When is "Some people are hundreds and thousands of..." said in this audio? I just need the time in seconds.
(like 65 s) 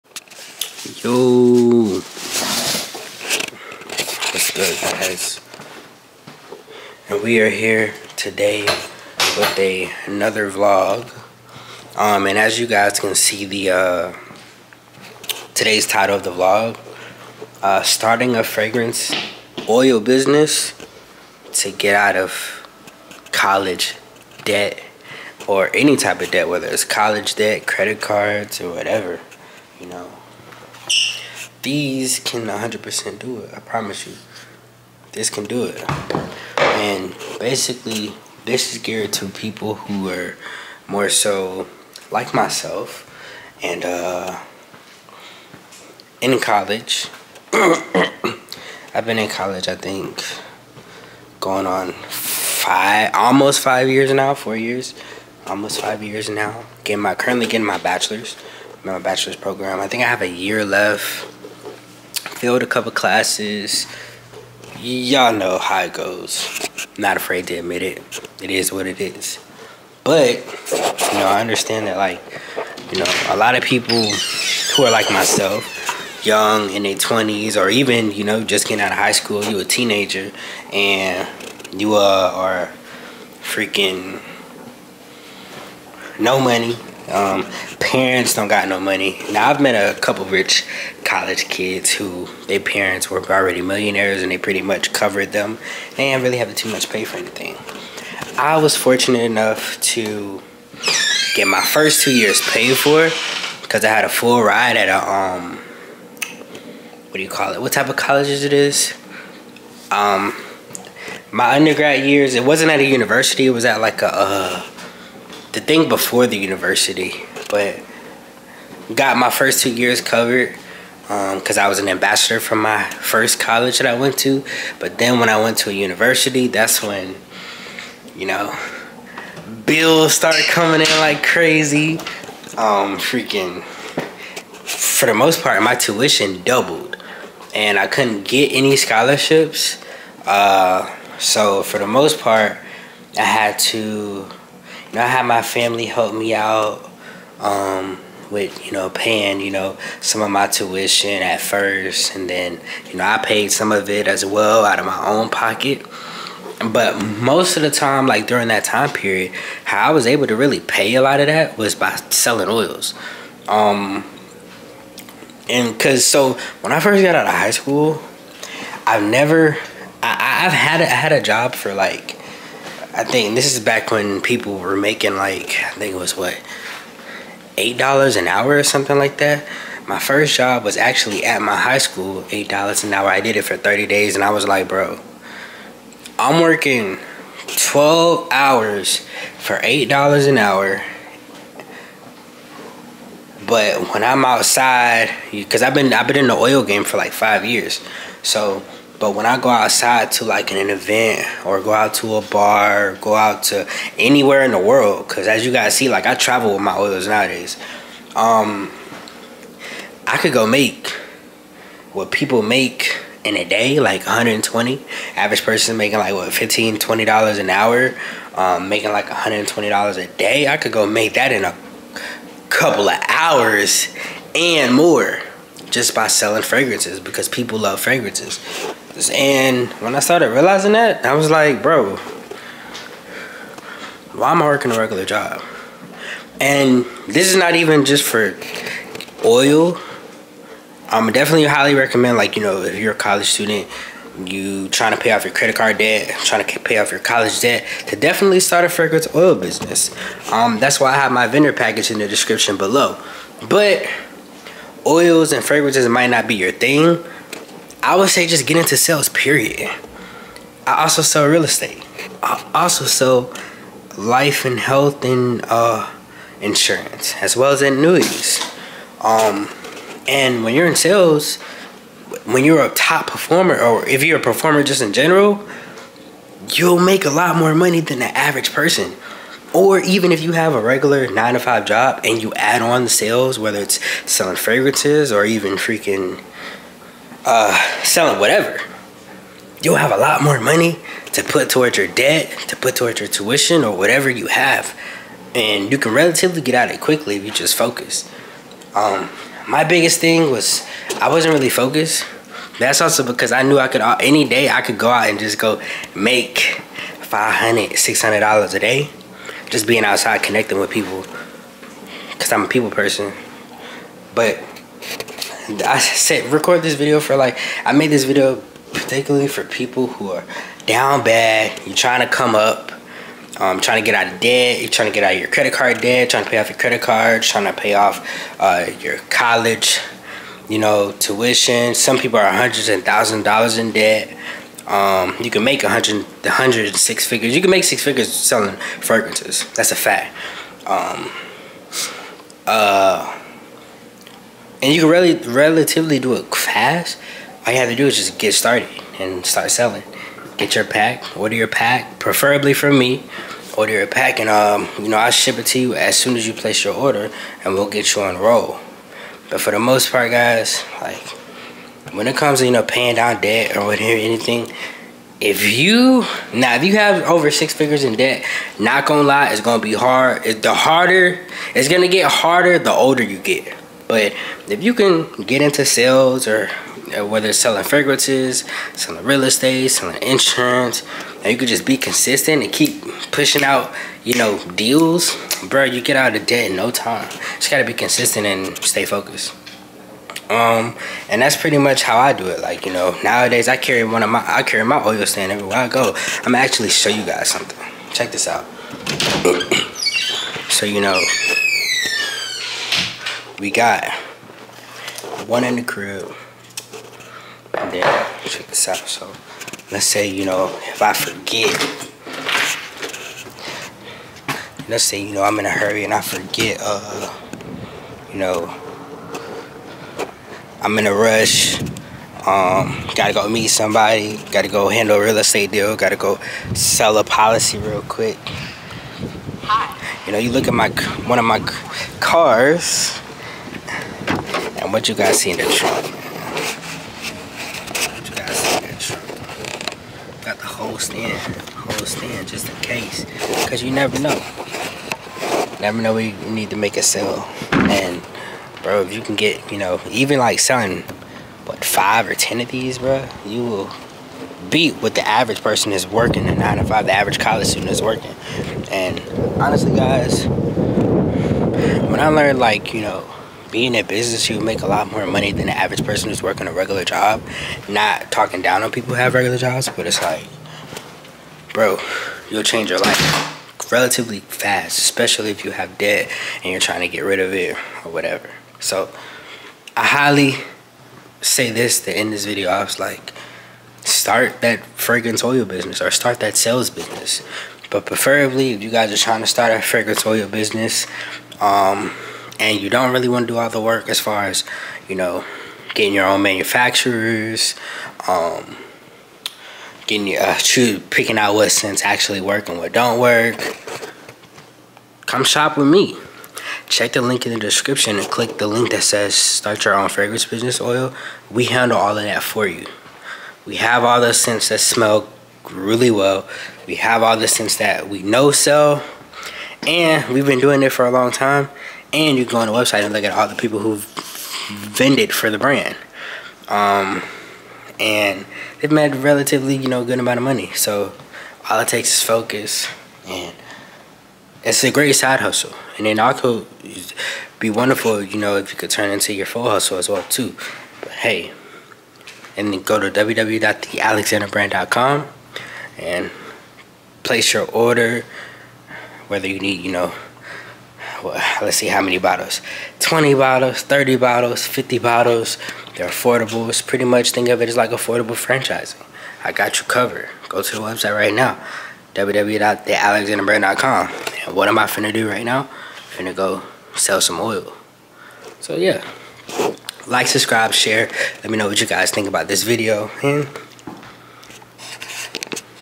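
331 s.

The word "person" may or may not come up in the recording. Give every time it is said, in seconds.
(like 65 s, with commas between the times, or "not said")
215 s, 278 s, 312 s, 455 s, 465 s.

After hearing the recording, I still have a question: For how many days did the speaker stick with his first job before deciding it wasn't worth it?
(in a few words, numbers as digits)
30 days.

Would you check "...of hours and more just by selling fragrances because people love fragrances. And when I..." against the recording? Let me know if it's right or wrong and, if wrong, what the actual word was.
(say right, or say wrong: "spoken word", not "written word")
right.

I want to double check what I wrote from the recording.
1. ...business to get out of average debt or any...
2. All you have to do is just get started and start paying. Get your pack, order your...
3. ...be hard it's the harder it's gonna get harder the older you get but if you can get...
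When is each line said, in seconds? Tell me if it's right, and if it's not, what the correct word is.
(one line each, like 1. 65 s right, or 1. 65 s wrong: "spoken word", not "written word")
1. 19 s wrong: "college", not "average"
2. 347 s wrong: "selling", not "paying"
3. 369 s right.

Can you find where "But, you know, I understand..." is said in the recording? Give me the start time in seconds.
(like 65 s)
70 s.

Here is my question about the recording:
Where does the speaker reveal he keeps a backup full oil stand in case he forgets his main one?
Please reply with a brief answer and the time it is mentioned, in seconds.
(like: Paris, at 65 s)
the trunk, at 438 s.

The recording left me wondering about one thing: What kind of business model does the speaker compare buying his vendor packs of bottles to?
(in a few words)
affordable franchising.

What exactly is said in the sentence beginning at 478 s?
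So I highly say this to end this video.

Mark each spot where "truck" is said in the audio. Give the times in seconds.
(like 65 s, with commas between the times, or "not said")
435 s.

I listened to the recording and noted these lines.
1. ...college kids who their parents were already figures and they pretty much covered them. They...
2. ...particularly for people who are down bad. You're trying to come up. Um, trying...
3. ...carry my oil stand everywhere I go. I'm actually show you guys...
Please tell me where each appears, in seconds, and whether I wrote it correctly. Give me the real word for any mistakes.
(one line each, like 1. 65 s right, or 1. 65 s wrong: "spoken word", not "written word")
1. 91 s wrong: "millionaires", not "figures"
2. 318 s right
3. 394 s right.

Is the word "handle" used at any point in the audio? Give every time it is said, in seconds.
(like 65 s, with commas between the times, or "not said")
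424 s, 511 s.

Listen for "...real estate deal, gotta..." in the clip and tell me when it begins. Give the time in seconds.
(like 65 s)
425 s.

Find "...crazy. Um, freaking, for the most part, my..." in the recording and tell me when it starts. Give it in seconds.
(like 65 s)
131 s.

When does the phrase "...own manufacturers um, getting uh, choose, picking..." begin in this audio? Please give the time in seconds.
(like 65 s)
496 s.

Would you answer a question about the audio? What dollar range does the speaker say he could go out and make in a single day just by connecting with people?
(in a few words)
$500 to $600.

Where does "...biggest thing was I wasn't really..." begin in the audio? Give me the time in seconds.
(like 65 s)
299 s.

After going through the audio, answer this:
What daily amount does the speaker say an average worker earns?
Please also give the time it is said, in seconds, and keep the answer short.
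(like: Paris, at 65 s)
$120, at 219 s.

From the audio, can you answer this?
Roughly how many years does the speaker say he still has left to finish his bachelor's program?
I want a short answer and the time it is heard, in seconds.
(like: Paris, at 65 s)
a year, at 60 s.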